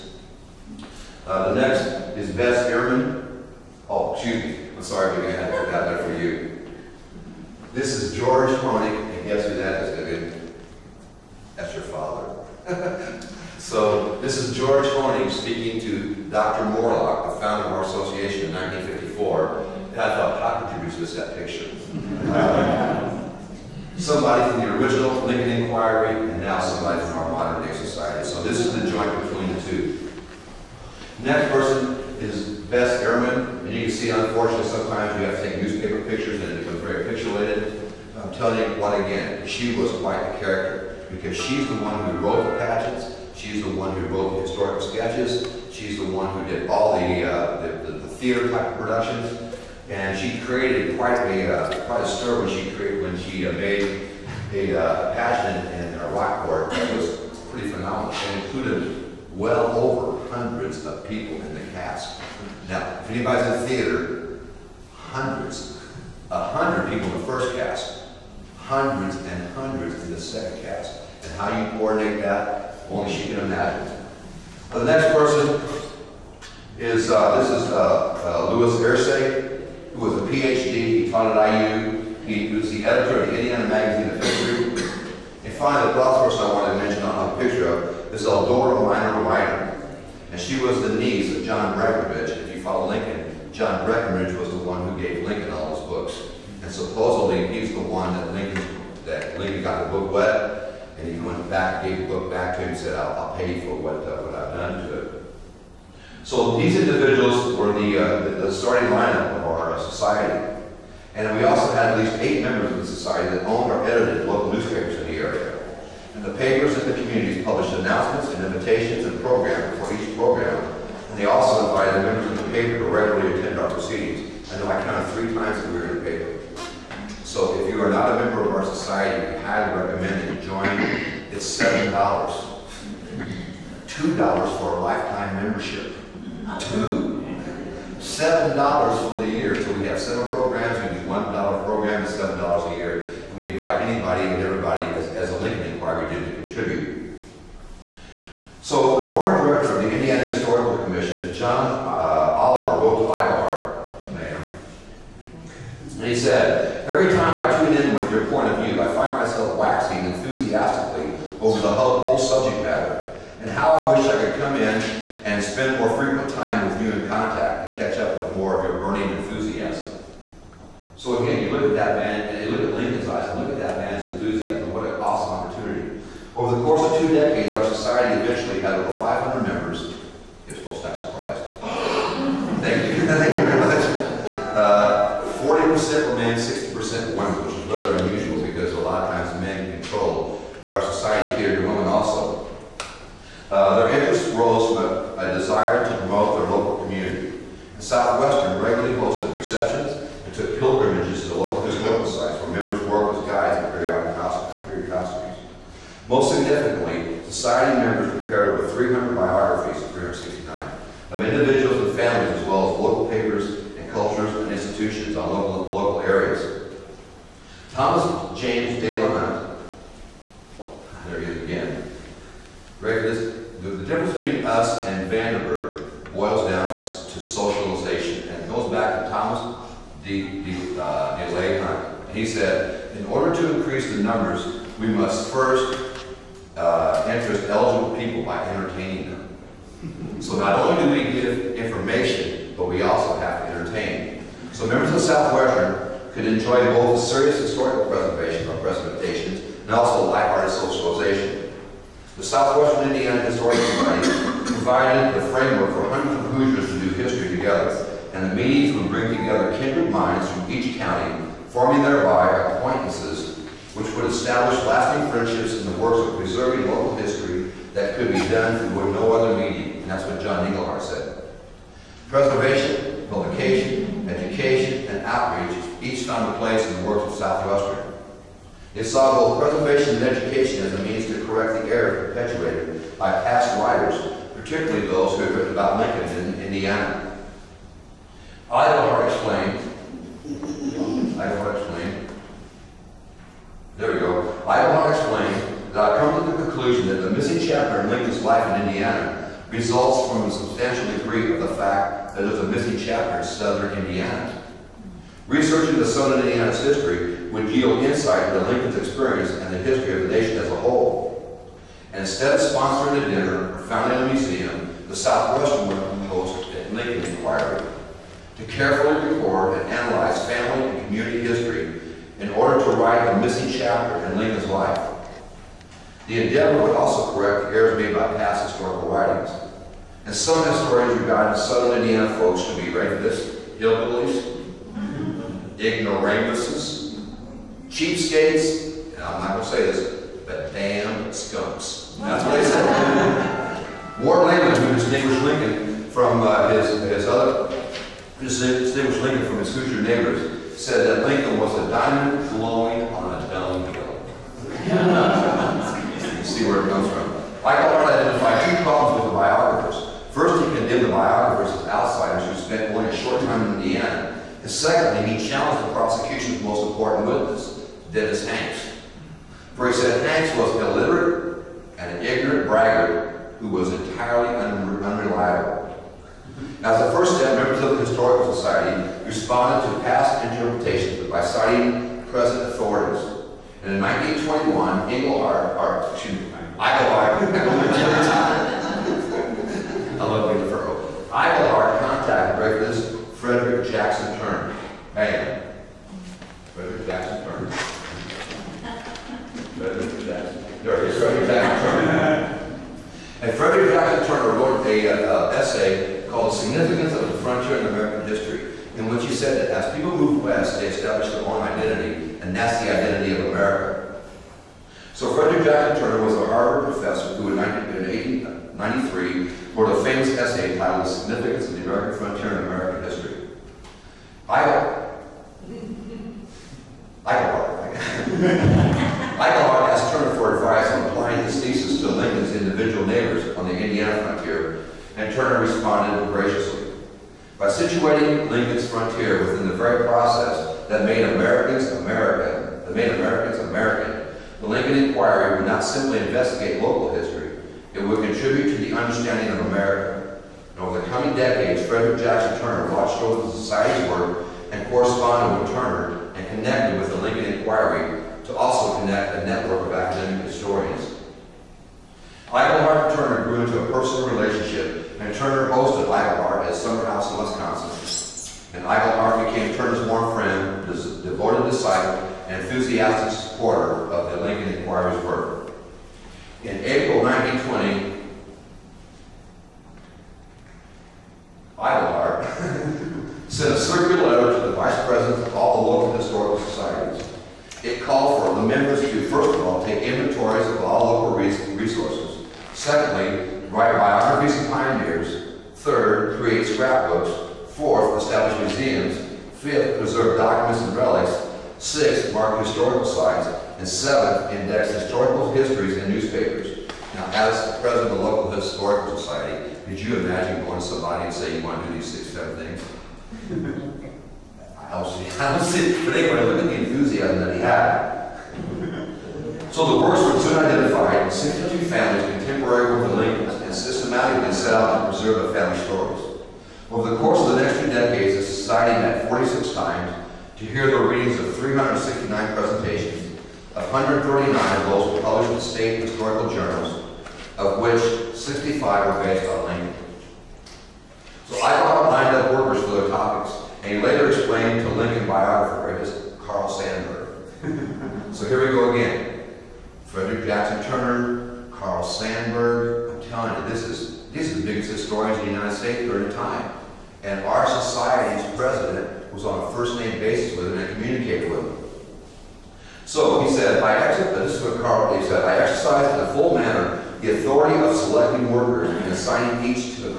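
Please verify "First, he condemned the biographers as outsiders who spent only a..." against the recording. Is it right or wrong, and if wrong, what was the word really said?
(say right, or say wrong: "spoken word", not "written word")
right.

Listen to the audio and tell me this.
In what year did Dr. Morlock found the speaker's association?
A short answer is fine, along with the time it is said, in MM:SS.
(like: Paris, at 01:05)
1954, at 00:18.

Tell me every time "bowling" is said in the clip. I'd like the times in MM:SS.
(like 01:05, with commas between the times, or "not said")
not said.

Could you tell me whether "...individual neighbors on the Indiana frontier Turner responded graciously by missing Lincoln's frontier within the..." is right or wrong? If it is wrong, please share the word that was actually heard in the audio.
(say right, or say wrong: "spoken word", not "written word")
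wrong: "situating", not "missing".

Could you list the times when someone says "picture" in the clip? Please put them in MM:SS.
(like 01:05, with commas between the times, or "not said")
00:21, 00:36, 01:27.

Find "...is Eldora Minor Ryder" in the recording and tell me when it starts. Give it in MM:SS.
01:28.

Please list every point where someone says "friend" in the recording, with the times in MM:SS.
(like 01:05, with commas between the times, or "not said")
07:50.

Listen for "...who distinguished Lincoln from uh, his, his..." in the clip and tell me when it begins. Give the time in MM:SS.
05:44.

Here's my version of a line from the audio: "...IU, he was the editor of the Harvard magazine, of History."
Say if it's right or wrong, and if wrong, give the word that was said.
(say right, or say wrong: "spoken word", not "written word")
wrong: "Indiana", not "Harvard".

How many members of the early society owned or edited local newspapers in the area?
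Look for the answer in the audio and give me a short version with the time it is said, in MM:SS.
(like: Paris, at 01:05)
8, at 01:52.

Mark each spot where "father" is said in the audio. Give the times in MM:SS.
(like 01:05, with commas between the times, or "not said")
00:11.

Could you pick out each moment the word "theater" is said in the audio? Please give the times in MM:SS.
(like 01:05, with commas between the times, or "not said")
00:48, 01:03.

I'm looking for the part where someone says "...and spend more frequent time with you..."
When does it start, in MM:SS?
02:45.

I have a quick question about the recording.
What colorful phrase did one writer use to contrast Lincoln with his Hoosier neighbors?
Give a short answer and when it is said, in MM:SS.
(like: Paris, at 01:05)
a diamond glowing on a dunghill, at 05:51.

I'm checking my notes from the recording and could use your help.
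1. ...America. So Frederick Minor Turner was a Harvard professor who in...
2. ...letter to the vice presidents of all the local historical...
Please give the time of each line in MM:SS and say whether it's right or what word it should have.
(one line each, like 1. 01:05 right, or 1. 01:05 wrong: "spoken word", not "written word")
1. 06:53 wrong: "Jackson", not "Minor"
2. 08:04 right.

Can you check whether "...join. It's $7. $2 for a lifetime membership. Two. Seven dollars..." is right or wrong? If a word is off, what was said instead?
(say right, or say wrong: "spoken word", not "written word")
right.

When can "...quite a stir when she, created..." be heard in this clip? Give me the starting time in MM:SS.
00:51.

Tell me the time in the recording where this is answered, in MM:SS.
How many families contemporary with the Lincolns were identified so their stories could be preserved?
08:41.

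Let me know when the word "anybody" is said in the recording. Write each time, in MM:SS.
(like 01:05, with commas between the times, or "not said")
01:03, 02:23.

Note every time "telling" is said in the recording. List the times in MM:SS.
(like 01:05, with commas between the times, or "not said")
00:38, 09:13.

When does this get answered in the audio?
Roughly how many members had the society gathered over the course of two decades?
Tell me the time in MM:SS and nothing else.
02:58.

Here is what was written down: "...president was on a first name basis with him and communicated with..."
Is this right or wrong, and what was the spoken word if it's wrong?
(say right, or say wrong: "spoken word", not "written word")
right.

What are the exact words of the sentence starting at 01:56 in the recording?
And the papers in the communities published announcements and invitations and programs for each program.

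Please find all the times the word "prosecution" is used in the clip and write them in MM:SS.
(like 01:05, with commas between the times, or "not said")
06:05.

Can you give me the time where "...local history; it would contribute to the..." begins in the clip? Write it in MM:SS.
07:26.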